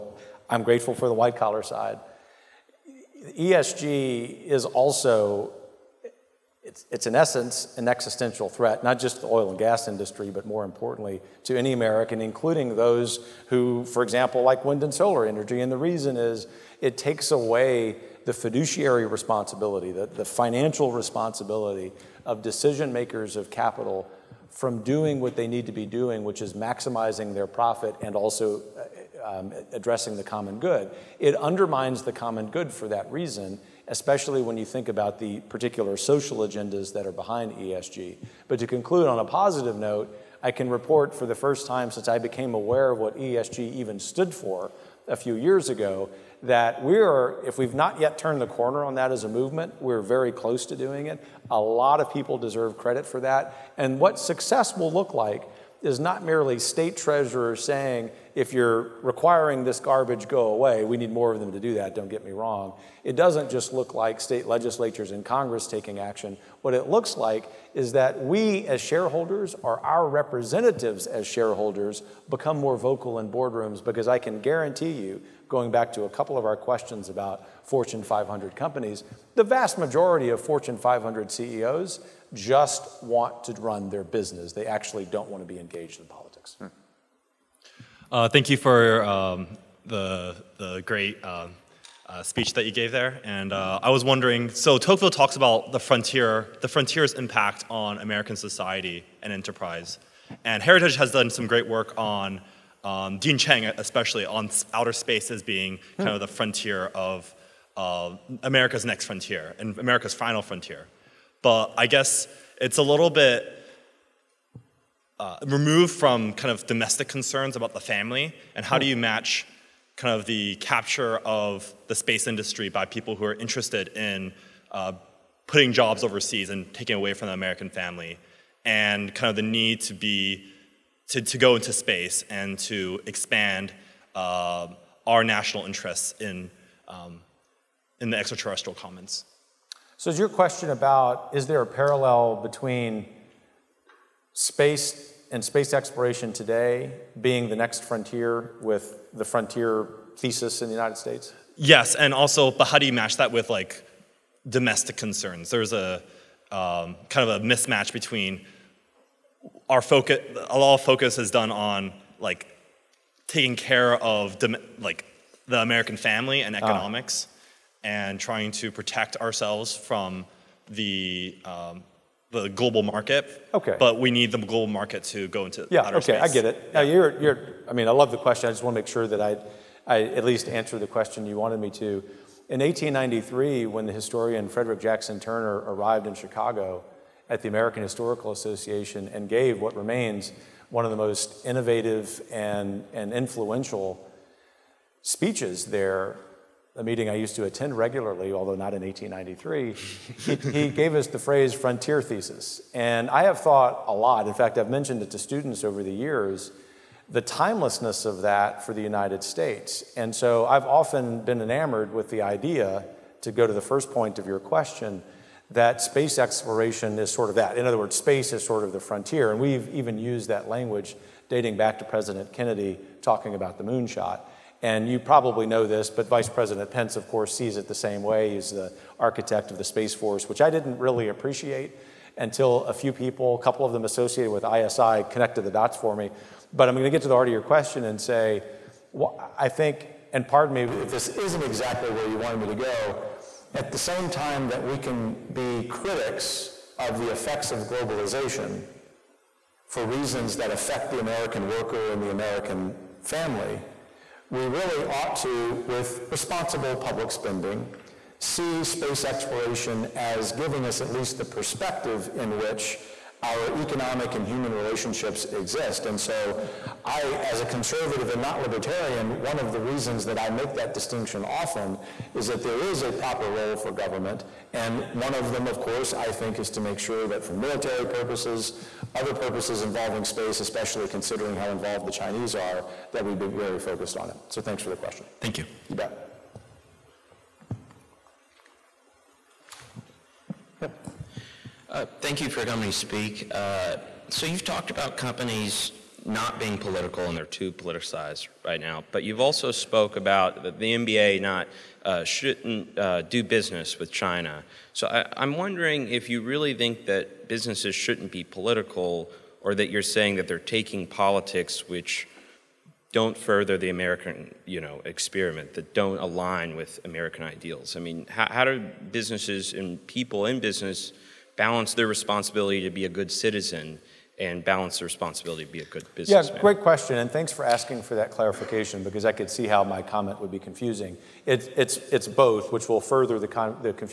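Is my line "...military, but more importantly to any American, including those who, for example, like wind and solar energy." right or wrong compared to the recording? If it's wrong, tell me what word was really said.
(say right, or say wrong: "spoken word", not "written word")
wrong: "industry", not "military".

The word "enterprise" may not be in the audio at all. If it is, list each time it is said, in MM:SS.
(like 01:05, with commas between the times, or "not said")
01:39.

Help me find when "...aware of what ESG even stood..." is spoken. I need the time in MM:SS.
00:42.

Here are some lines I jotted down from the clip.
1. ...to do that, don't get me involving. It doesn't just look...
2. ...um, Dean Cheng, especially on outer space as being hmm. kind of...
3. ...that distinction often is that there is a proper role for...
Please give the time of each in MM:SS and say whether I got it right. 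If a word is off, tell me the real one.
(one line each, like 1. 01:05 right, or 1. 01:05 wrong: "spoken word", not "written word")
1. 01:01 wrong: "wrong", not "involving"
2. 01:42 right
3. 04:30 right.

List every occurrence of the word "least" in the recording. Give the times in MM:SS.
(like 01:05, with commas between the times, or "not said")
03:00, 04:20.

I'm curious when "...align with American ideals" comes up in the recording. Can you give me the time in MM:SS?
05:15.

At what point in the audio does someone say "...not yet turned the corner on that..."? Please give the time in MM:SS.
00:47.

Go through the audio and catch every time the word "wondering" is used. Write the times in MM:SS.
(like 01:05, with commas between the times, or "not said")
01:34, 05:05.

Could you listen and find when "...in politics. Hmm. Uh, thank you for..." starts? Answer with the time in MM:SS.
01:25.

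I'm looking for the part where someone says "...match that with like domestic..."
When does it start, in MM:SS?
02:32.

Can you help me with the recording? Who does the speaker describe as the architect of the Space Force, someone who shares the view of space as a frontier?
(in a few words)
Vice President Pence.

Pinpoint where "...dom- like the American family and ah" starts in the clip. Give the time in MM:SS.
02:44.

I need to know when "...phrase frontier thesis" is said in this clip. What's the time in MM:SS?
03:21.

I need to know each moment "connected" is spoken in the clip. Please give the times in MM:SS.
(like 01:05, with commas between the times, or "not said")
03:55.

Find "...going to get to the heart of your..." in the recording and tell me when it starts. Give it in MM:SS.
03:56.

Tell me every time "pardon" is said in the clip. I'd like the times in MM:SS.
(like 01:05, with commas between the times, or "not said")
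04:00.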